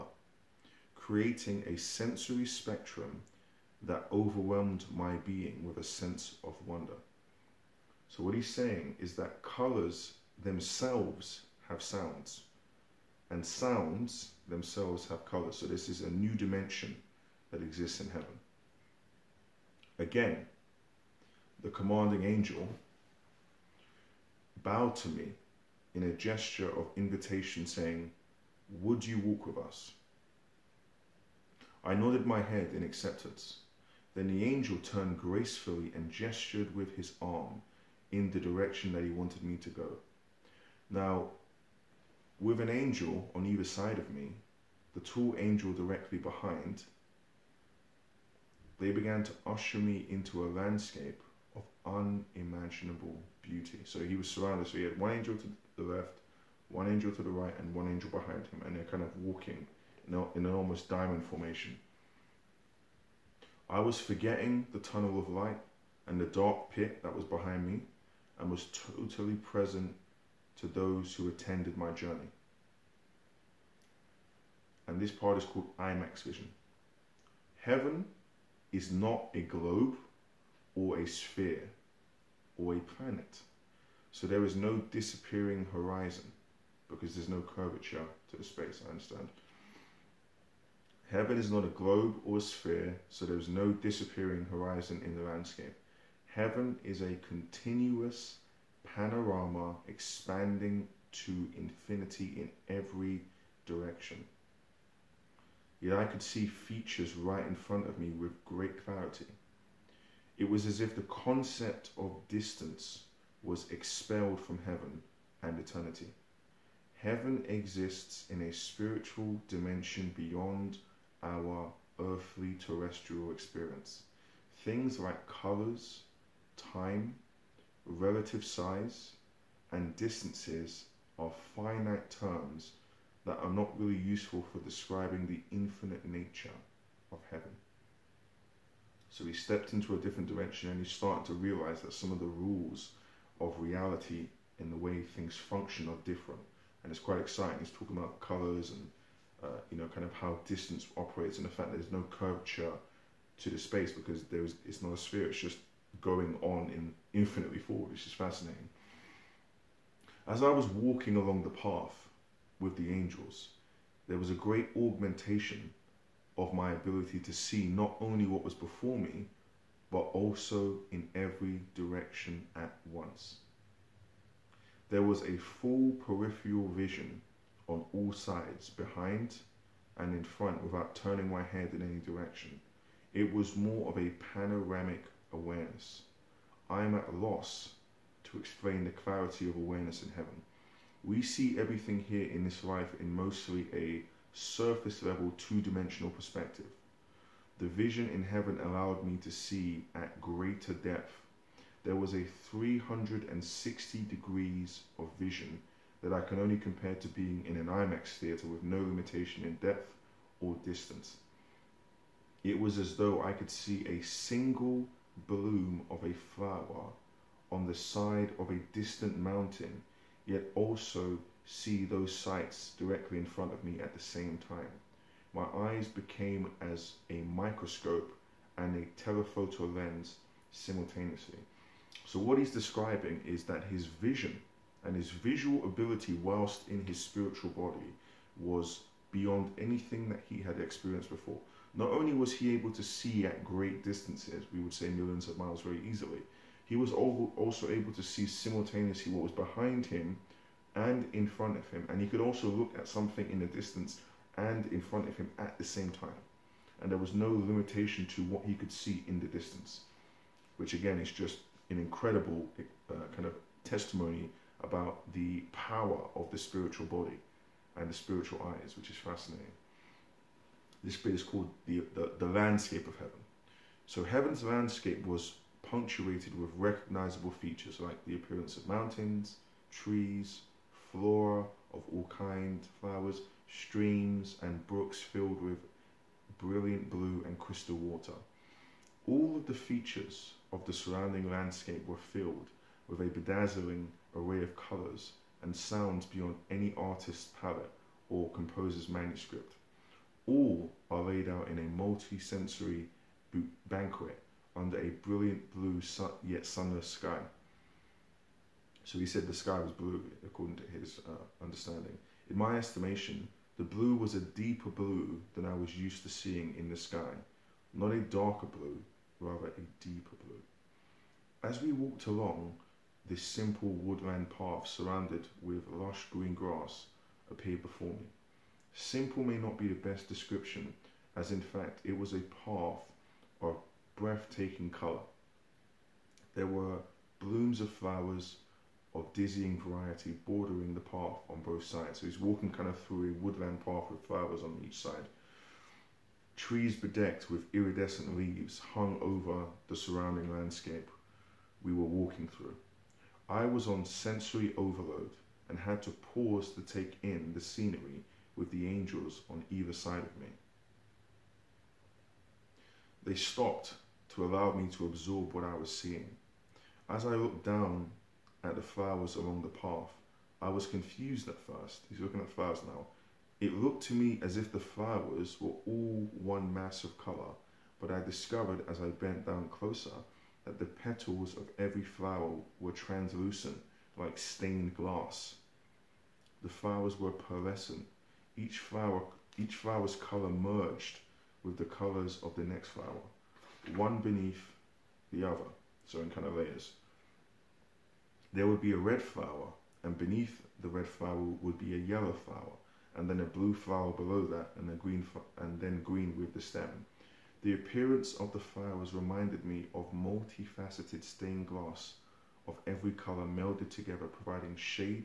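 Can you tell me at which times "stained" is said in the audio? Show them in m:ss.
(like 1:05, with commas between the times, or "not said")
6:24, 6:51.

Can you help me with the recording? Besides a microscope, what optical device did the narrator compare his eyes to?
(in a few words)
Telephoto lens.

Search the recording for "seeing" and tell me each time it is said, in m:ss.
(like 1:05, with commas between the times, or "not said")
5:16, 6:05.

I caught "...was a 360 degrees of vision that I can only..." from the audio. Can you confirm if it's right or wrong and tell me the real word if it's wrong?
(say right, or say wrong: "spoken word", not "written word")
right.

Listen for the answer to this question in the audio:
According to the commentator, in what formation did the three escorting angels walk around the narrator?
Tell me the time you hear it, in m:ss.
1:00.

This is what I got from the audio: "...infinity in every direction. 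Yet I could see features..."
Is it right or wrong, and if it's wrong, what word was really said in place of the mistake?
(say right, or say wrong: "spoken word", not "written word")
right.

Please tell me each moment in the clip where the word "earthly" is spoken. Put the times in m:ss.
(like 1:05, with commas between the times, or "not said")
2:01.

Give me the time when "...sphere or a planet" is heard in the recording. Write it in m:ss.
1:21.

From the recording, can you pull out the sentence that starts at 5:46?
Trees bedecked with iridescent leaves hung over the surrounding landscape we were walking through.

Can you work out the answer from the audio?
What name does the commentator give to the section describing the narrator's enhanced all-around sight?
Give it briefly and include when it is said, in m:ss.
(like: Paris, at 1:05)
IMAX vision, at 1:15.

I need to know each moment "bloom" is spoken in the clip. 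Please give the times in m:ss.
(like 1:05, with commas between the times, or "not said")
3:35, 5:37.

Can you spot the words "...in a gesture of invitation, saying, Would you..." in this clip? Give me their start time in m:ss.
0:25.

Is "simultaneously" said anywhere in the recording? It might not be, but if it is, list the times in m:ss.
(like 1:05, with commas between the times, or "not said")
3:50, 4:08.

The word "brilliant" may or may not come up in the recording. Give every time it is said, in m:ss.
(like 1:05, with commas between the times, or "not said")
4:46, 5:05.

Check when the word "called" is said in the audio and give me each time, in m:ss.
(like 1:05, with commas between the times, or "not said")
1:15, 4:31.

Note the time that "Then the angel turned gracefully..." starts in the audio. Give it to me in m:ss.
0:34.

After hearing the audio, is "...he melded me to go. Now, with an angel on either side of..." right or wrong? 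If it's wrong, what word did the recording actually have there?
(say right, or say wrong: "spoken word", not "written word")
wrong: "wanted", not "melded".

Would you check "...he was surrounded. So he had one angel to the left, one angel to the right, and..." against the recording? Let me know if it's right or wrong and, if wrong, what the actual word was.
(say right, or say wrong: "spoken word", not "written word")
right.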